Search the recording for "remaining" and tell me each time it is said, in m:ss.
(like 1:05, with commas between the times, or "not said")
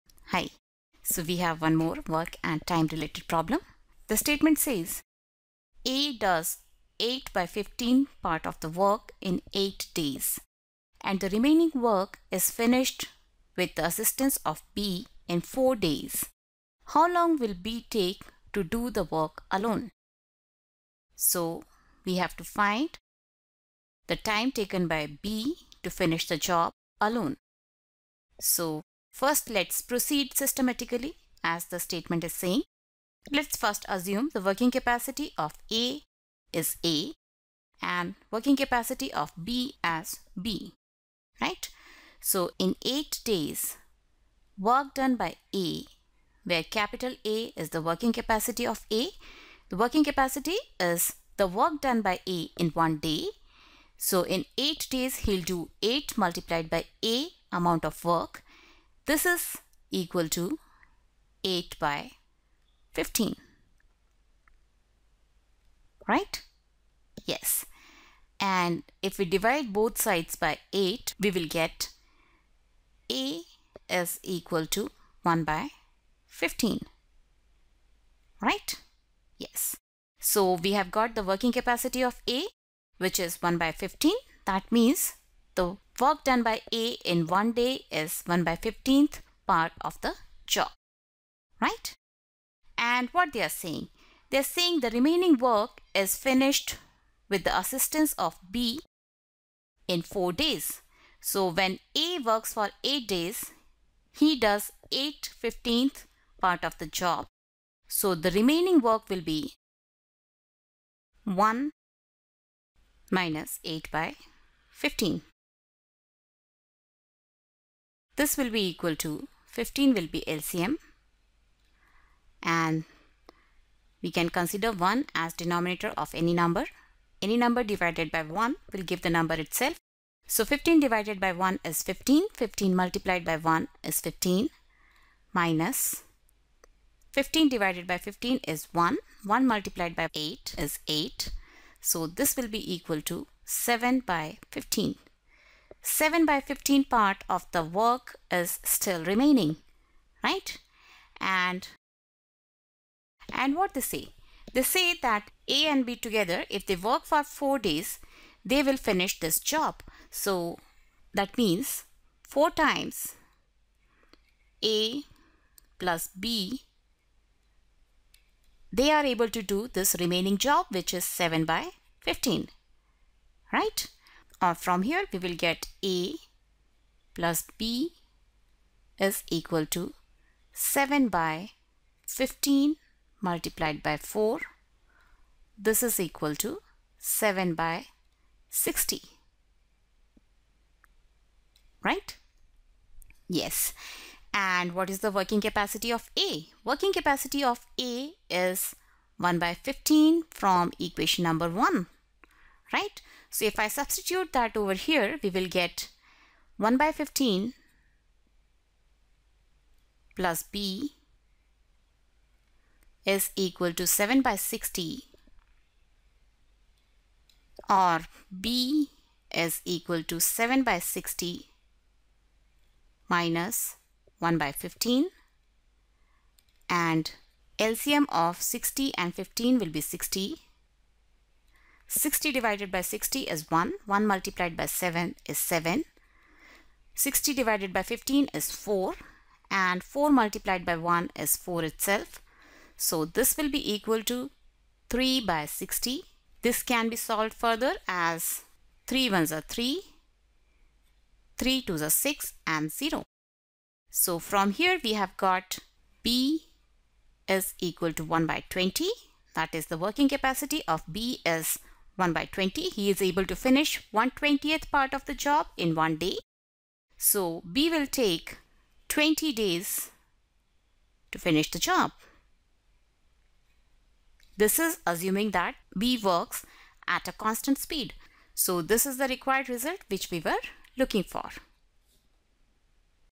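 0:11, 1:34, 1:48, 2:29, 2:49.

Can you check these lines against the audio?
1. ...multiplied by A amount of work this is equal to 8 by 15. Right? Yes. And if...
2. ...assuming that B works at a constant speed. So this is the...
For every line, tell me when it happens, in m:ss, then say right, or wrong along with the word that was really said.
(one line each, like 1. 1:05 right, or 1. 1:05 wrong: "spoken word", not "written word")
1. 0:56 right
2. 4:34 right.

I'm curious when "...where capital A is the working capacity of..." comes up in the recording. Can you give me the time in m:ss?
0:46.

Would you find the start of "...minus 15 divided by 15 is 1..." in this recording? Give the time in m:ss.
2:15.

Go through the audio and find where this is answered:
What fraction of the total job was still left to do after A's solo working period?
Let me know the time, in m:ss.
2:25.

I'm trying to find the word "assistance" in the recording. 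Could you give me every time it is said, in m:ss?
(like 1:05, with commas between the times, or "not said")
0:13, 1:37.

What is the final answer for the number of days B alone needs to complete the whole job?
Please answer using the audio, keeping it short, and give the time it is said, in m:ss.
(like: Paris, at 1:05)
20 days, at 4:28.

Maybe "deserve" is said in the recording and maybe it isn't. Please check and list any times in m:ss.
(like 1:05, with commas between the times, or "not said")
not said.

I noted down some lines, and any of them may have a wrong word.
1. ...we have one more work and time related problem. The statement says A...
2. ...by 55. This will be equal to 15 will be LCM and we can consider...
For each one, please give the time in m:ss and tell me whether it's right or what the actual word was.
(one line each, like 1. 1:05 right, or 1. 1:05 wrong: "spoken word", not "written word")
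1. 0:01 right
2. 1:53 wrong: "15", not "55".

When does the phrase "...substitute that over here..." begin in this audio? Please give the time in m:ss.
3:23.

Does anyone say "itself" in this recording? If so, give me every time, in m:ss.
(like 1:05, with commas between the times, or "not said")
2:09, 4:01.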